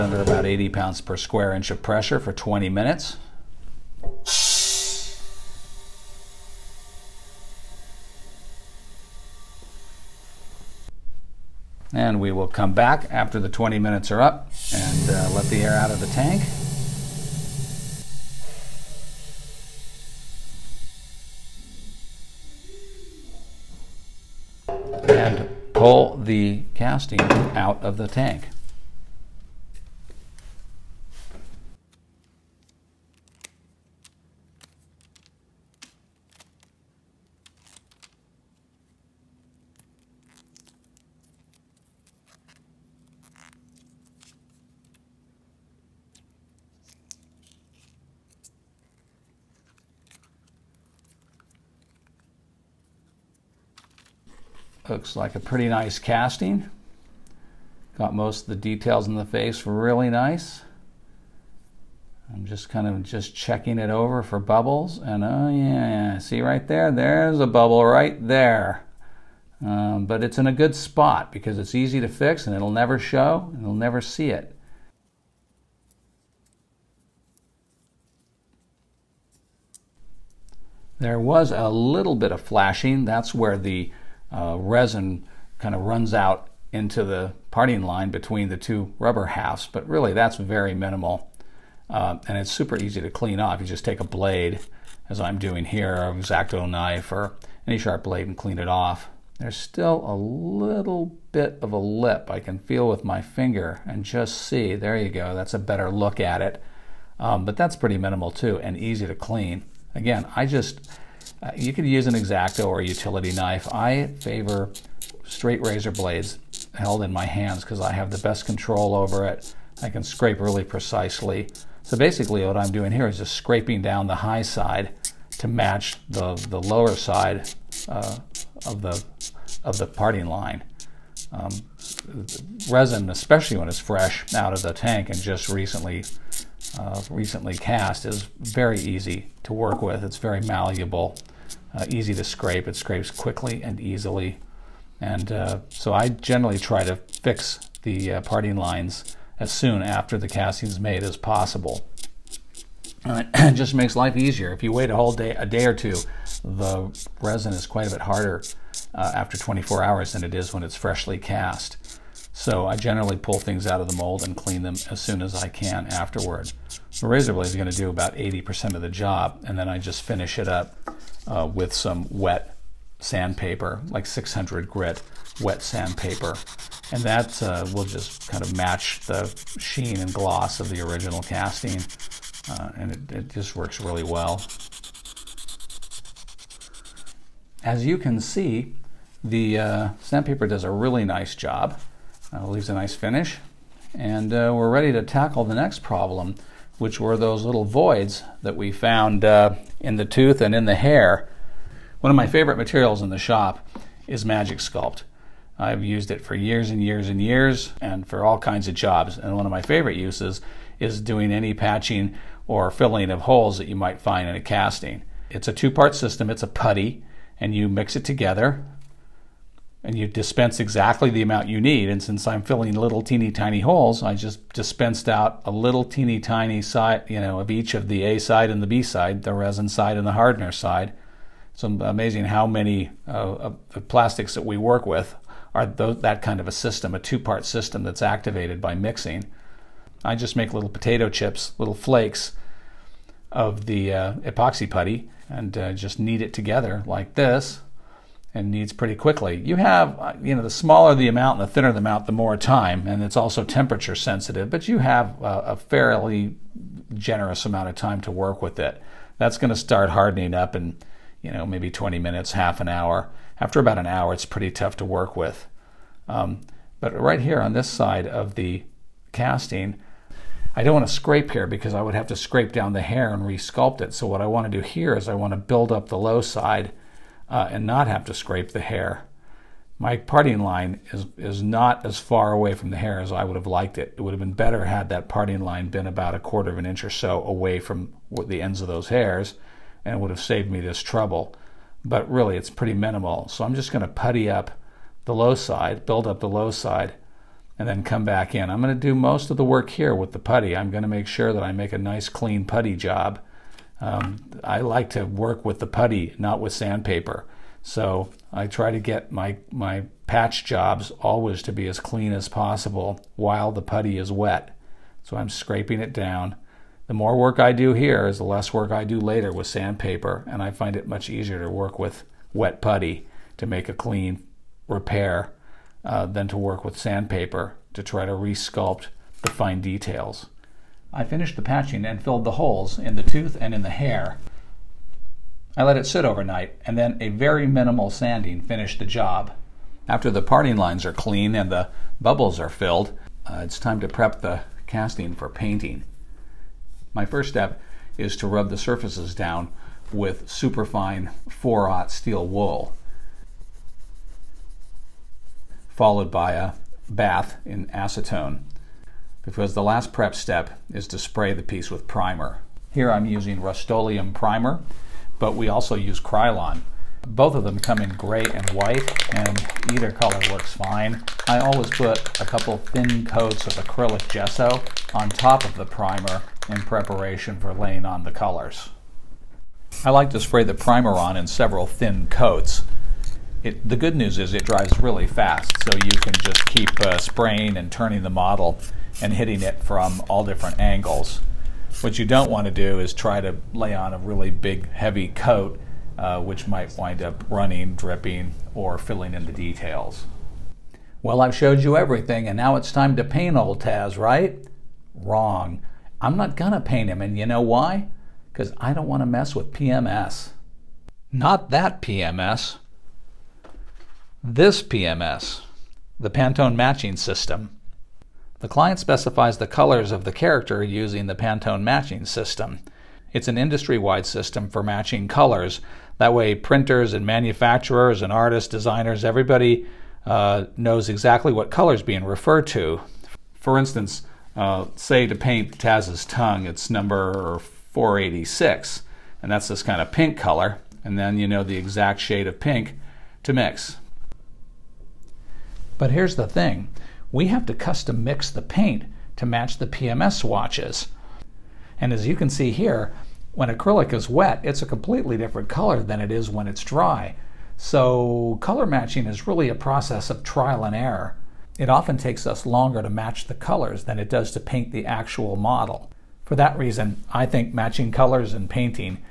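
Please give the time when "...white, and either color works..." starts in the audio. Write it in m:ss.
6:08.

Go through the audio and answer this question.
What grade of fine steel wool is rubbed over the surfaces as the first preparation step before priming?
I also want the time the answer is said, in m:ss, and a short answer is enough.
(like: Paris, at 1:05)
4-aught, at 5:51.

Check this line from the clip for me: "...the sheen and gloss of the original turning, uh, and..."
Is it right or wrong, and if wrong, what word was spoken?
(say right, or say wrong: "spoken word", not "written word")
wrong: "casting", not "turning".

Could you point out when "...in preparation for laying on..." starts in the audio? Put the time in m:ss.
6:16.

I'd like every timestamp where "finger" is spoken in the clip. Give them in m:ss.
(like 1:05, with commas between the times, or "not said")
1:43.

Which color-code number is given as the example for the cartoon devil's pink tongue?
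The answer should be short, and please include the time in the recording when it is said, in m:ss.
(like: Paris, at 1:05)
486, at 7:17.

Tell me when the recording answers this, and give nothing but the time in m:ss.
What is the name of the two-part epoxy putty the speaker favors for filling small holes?
3:24.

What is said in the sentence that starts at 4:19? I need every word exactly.
That's going to start hardening up in, you know, maybe 20 minutes, half an hour.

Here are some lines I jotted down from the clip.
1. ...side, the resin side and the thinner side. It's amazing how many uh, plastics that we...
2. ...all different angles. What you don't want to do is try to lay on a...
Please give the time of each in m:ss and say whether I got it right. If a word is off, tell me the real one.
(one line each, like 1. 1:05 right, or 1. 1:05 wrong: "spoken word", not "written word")
1. 3:48 wrong: "hardener", not "thinner"
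2. 6:30 right.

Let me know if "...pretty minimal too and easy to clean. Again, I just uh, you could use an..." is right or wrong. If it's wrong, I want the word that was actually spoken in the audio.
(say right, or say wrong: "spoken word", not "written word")
right.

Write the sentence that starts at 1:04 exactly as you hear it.
And oh yeah, see right there?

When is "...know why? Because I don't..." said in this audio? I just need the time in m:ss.
6:47.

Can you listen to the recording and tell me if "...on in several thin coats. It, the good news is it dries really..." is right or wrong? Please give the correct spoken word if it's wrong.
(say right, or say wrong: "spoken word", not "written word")
right.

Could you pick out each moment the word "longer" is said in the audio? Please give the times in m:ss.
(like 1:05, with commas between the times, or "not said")
7:42.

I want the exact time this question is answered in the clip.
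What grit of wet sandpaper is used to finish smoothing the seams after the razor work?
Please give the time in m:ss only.
2:54.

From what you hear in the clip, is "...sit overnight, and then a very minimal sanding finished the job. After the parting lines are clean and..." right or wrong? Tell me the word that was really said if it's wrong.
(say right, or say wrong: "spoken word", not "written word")
right.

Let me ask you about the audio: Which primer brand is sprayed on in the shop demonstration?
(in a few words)
Rust-Oleum.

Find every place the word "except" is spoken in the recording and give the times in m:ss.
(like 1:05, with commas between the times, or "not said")
not said.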